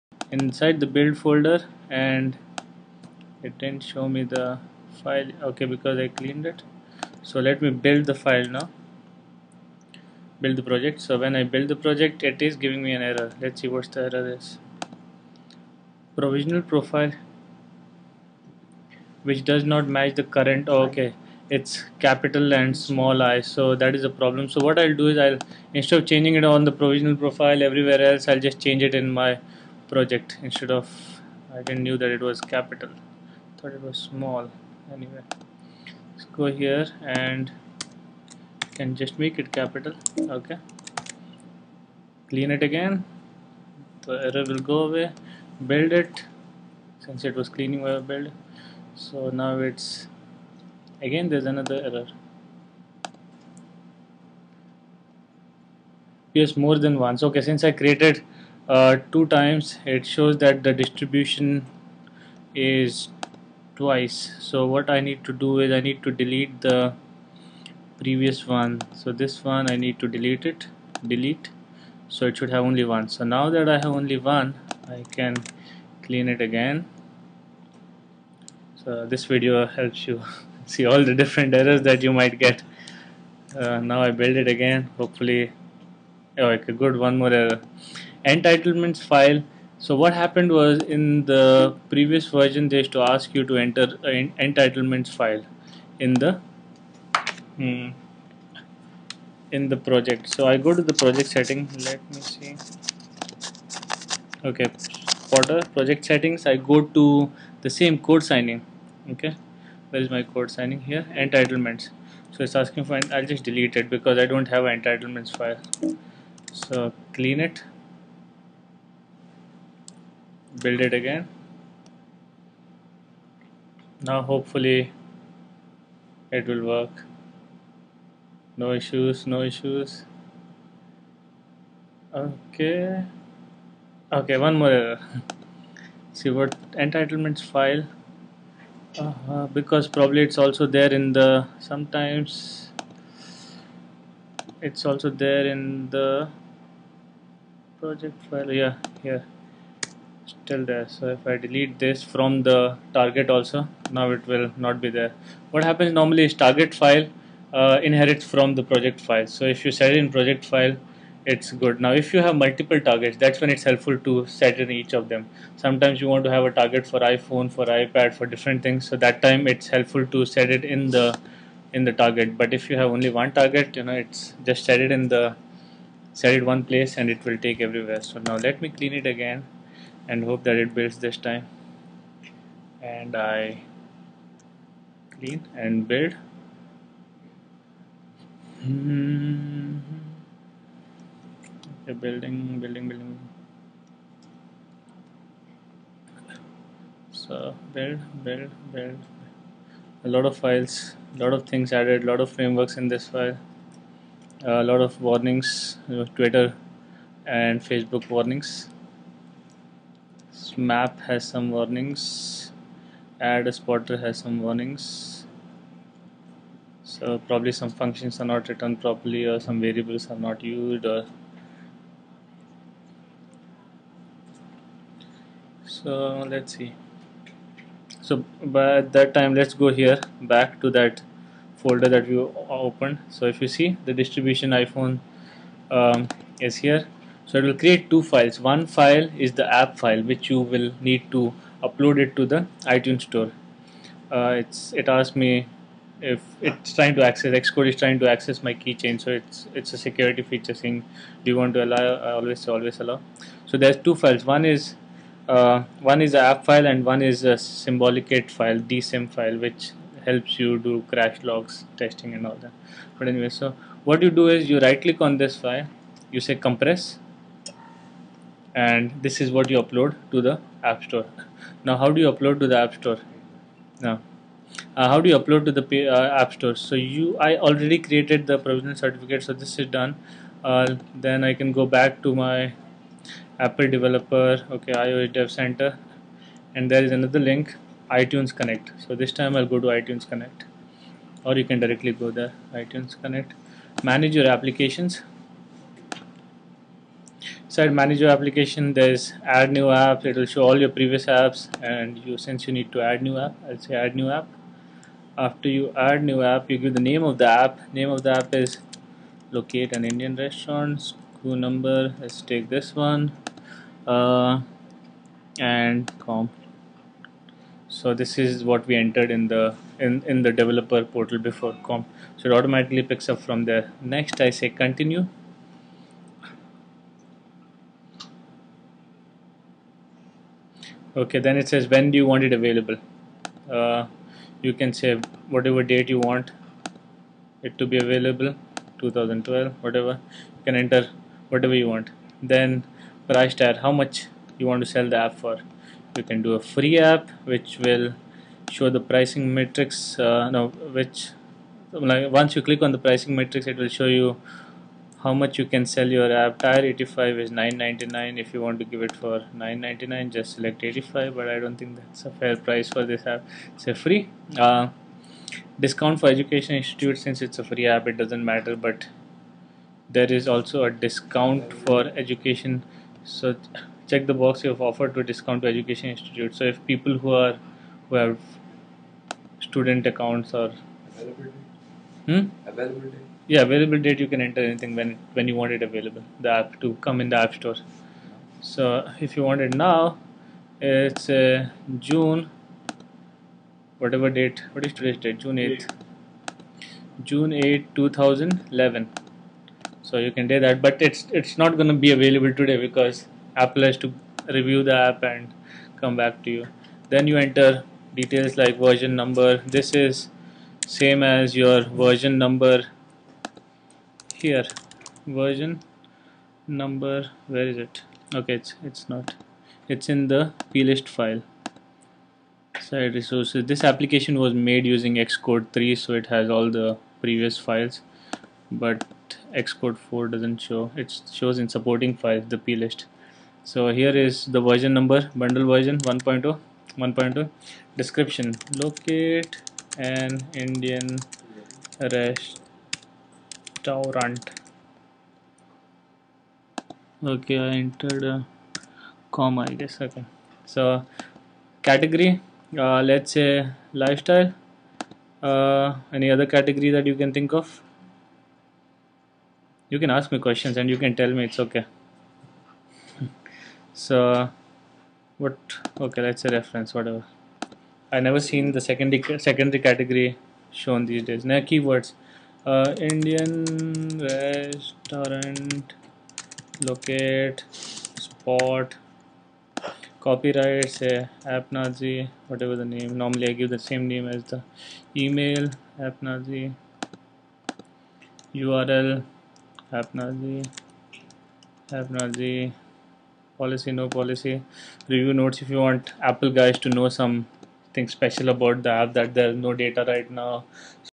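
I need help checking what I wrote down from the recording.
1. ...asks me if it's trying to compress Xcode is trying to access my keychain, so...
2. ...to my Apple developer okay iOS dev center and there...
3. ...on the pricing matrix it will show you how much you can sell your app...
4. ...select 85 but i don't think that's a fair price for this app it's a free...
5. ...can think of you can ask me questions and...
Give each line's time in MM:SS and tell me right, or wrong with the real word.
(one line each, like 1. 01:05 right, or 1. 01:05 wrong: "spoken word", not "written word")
1. 04:04 wrong: "access", not "compress"
2. 04:42 right
3. 05:52 right
4. 06:00 right
5. 07:36 right.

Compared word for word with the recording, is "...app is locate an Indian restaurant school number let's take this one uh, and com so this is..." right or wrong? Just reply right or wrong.
right.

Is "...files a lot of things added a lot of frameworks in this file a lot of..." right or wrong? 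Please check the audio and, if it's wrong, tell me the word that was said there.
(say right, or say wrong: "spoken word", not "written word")
right.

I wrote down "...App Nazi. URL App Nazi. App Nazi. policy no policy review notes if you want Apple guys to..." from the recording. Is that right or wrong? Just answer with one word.
right.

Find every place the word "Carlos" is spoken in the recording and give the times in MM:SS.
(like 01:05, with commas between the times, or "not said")
not said.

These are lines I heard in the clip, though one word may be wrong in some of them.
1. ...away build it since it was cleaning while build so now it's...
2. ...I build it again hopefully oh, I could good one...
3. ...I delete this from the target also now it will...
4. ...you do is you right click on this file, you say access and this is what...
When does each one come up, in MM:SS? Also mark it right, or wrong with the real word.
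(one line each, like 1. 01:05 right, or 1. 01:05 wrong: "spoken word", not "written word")
1. 00:44 right
2. 01:24 right
3. 02:31 right
4. 04:24 wrong: "compress", not "access".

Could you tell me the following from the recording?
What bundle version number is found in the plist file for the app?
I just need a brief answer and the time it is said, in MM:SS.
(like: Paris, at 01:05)
1.2, at 07:16.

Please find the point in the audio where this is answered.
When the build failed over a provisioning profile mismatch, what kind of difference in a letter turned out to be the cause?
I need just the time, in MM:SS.
00:21.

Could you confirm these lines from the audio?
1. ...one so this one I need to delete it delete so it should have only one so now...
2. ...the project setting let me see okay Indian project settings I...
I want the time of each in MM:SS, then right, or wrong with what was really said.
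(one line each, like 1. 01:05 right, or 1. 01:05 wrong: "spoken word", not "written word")
1. 01:08 right
2. 01:40 wrong: "Potter", not "Indian".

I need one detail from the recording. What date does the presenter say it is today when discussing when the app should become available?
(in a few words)
June 8, 2011.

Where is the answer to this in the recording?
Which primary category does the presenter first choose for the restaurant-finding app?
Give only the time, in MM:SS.
07:33.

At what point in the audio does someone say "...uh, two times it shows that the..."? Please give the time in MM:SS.
00:58.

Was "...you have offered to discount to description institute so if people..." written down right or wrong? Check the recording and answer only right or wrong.
wrong.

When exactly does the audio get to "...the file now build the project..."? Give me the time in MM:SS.
00:08.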